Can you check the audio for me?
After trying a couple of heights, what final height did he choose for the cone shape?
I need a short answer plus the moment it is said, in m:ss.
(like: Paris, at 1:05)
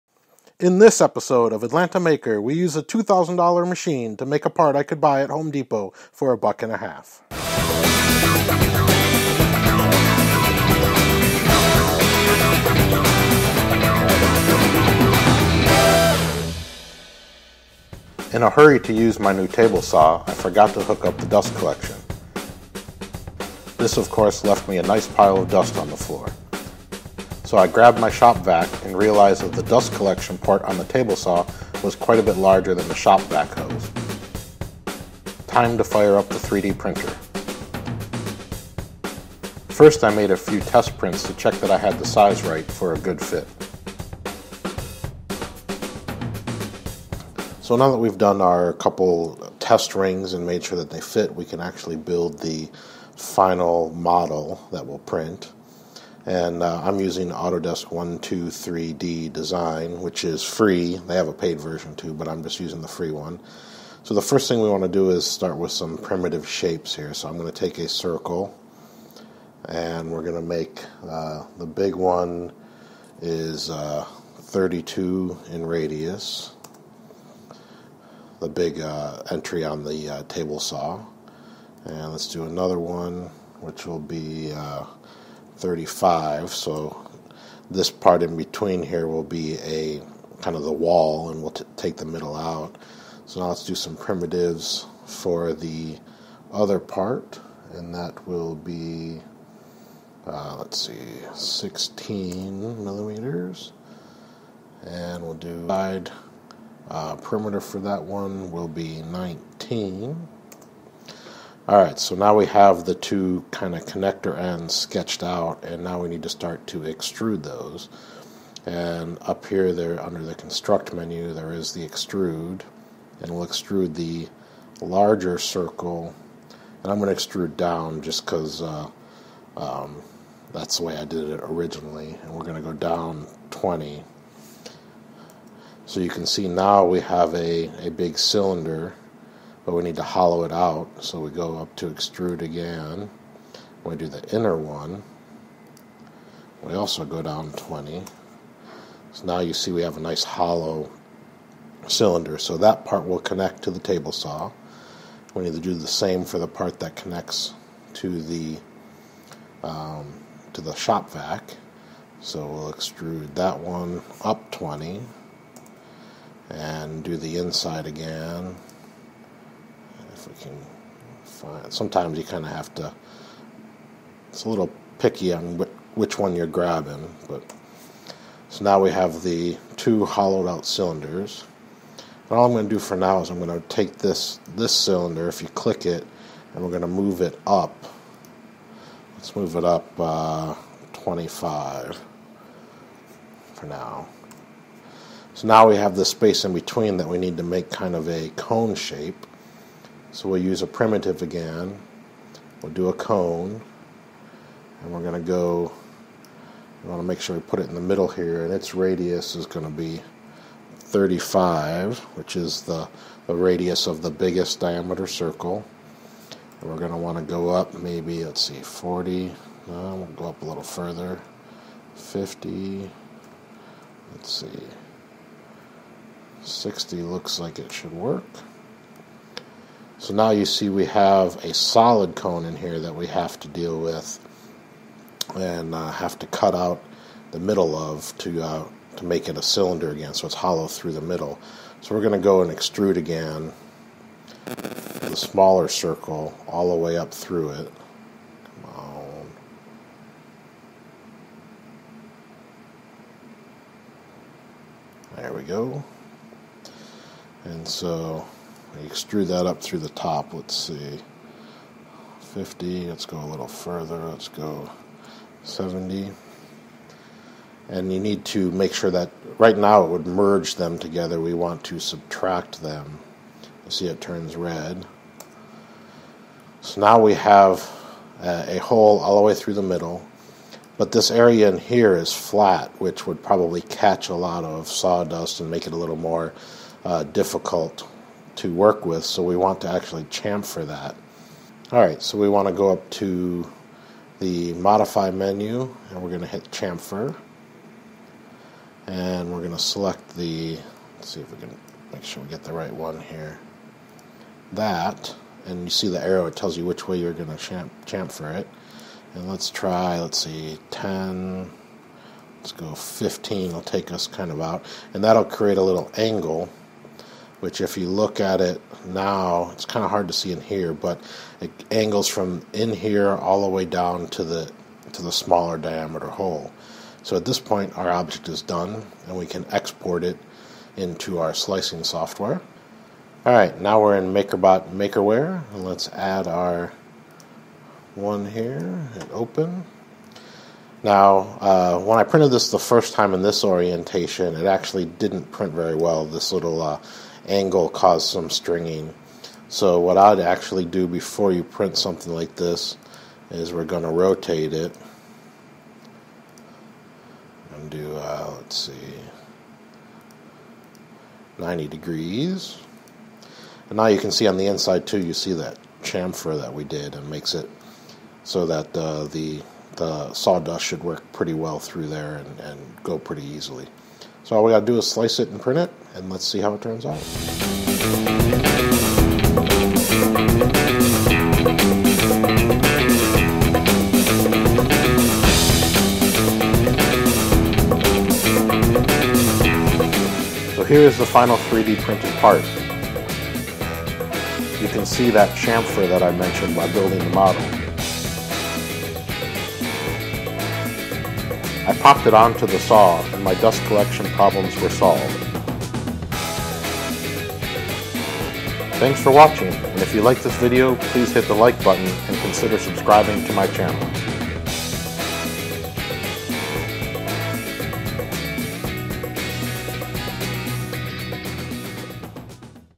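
60, at 3:46.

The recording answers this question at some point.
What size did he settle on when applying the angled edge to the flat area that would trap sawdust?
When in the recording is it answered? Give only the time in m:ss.
5:12.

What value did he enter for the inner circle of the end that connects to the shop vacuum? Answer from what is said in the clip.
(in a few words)
16 millimeters.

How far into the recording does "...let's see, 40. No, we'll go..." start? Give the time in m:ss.
3:38.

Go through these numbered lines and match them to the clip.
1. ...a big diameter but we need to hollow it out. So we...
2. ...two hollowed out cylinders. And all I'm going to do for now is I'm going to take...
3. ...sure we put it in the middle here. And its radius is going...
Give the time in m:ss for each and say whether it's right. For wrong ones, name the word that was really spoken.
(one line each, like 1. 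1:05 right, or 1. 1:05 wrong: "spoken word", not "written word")
1. 2:17 wrong: "cylinder", not "diameter"
2. 2:59 right
3. 3:27 right.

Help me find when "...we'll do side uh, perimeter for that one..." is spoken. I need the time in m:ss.
1:45.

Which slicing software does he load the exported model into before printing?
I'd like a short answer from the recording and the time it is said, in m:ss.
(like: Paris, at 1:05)
MakerBot Makerware, at 5:34.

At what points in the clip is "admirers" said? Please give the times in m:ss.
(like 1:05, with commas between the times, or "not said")
not said.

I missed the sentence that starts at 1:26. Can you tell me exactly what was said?
So this part in between here will be a kind of the wall, and we'll t- take the middle out.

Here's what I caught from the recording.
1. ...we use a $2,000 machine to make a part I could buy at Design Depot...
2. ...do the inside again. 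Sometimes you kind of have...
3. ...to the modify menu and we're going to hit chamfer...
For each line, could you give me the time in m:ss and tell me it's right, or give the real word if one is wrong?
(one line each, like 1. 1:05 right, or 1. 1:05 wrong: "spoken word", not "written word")
1. 0:02 wrong: "Home", not "Design"
2. 2:47 right
3. 4:53 right.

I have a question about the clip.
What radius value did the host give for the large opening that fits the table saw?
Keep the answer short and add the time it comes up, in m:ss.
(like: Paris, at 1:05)
32, at 1:14.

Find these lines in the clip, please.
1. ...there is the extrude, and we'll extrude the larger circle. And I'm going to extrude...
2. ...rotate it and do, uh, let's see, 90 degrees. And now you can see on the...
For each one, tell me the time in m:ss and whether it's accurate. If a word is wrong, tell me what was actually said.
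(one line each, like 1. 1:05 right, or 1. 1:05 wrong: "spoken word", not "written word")
1. 2:01 right
2. 5:53 right.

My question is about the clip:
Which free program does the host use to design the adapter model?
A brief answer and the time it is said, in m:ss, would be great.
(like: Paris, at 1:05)
Autodesk 123D Design, at 0:57.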